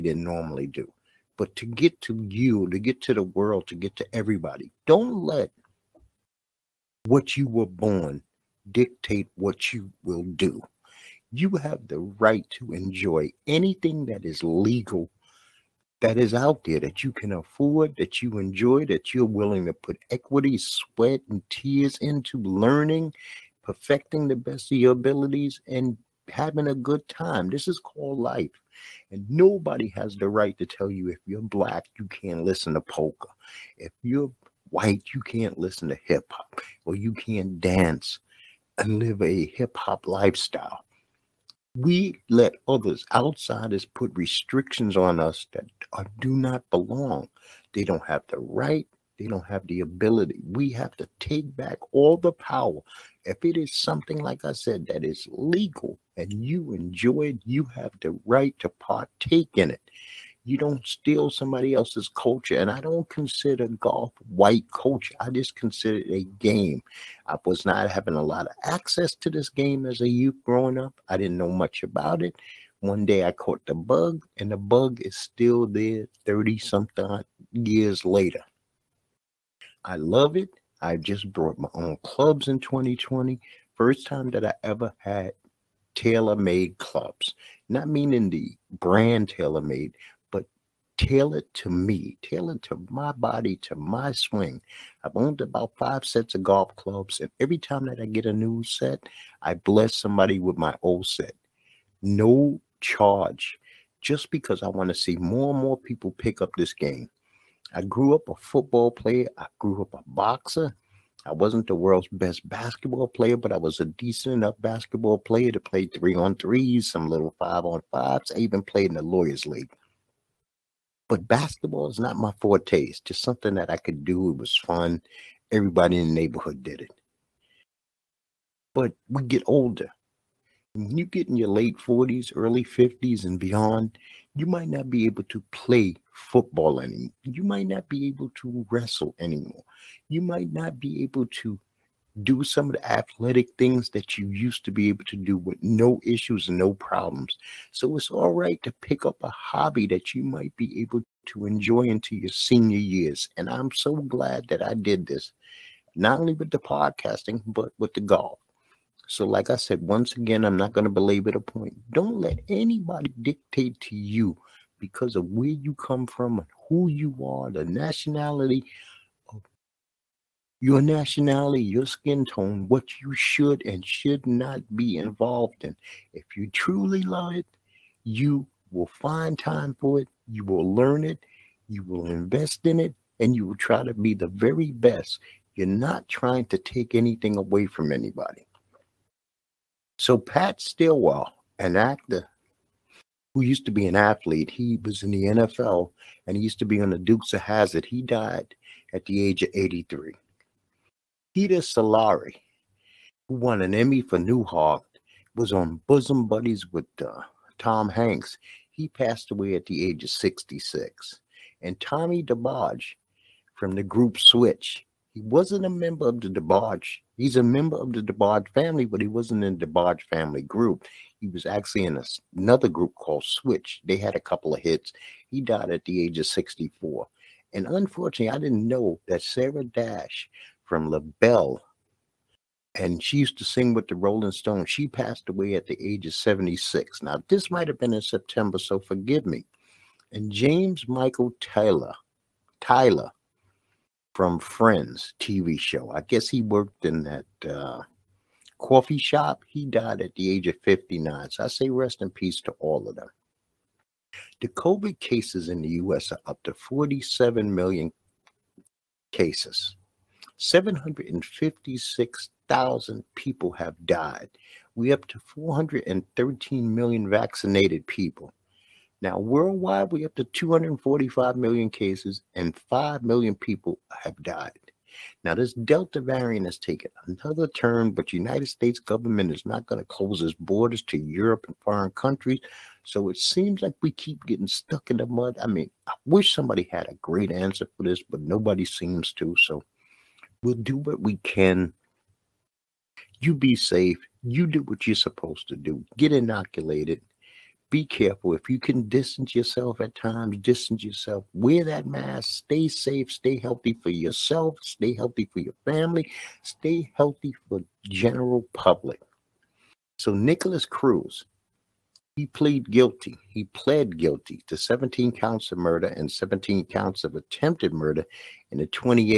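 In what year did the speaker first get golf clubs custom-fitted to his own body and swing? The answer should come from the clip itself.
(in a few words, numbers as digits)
2020.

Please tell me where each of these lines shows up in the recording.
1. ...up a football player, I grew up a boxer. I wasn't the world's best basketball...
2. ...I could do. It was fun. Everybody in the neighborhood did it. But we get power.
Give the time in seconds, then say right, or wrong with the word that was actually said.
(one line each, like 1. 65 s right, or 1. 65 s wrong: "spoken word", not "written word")
1. 108 s right
2. 123 s wrong: "older", not "power".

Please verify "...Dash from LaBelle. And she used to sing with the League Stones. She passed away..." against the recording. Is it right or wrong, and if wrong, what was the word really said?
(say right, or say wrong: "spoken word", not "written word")
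wrong: "Rolling", not "League".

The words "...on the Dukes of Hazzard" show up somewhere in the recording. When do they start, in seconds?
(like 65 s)
196 s.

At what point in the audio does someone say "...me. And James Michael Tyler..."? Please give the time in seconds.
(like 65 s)
239 s.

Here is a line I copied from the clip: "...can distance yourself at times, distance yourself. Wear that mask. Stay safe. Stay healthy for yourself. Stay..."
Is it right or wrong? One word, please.
right.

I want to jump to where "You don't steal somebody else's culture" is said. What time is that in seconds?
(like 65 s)
60 s.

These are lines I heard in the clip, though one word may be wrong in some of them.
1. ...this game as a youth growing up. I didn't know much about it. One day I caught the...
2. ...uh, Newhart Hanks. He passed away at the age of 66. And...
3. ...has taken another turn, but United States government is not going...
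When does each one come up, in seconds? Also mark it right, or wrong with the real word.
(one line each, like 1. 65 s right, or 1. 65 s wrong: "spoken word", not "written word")
1. 69 s right
2. 207 s wrong: "Tom", not "Newhart"
3. 276 s right.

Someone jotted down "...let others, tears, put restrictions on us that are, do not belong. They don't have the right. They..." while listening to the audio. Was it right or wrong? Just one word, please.
wrong.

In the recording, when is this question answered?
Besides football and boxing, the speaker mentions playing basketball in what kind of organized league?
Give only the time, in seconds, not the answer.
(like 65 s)
119 s.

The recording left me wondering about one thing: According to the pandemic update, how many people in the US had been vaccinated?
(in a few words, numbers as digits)
413 million.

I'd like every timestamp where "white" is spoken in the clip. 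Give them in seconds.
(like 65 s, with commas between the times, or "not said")
34 s, 64 s.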